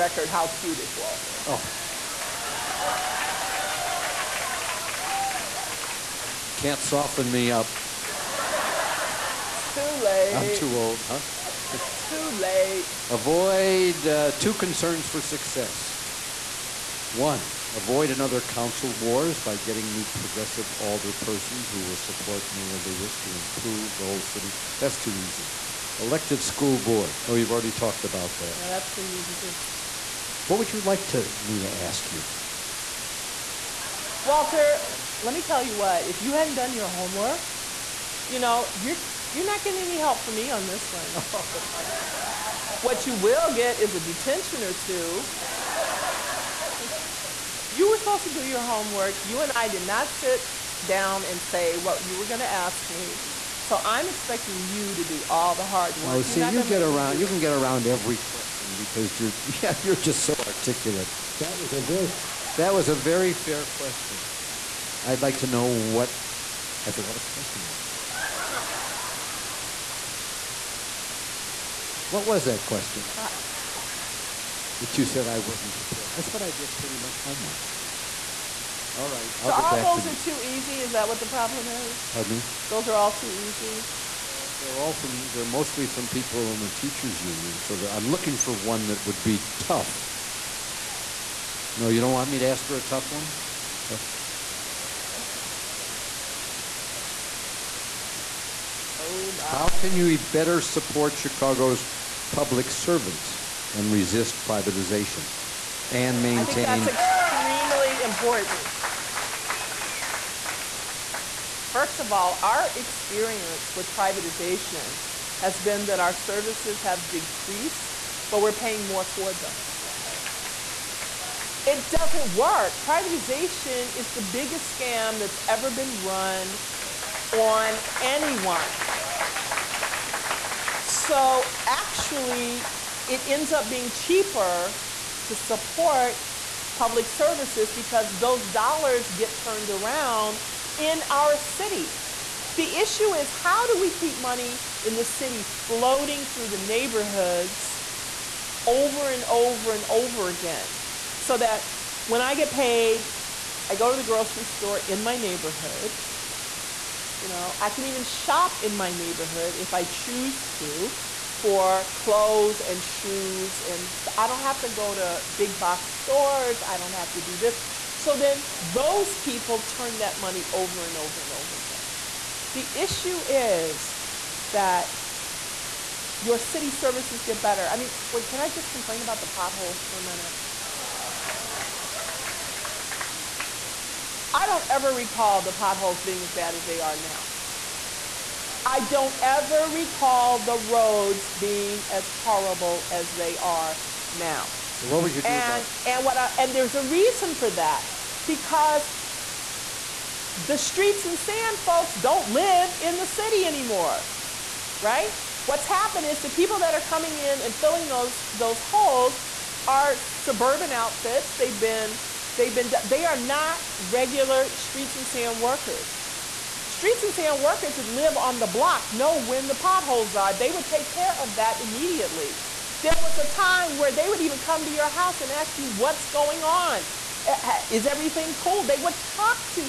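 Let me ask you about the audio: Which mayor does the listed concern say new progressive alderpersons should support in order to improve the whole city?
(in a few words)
Mayor Lewis.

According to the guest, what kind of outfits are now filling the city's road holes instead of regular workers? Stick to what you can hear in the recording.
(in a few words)
suburban outfits.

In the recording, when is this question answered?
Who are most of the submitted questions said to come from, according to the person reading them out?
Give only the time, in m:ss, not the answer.
1:26.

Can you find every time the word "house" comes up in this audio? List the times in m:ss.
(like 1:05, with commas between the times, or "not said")
3:44.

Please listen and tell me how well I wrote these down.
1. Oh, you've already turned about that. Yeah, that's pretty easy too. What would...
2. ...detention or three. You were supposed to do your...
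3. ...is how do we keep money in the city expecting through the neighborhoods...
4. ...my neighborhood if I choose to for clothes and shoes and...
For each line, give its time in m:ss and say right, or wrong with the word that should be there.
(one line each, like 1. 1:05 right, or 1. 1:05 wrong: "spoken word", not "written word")
1. 0:27 wrong: "talked", not "turned"
2. 0:44 wrong: "two", not "three"
3. 2:23 wrong: "floating", not "expecting"
4. 2:38 right.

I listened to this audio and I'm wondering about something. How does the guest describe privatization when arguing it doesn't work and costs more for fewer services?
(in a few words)
the biggest scam.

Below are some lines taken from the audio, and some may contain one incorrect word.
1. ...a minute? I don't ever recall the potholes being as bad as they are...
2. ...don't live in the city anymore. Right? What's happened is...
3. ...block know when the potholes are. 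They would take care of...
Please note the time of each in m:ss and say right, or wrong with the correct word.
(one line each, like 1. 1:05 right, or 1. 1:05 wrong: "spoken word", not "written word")
1. 2:59 right
2. 3:21 right
3. 3:38 right.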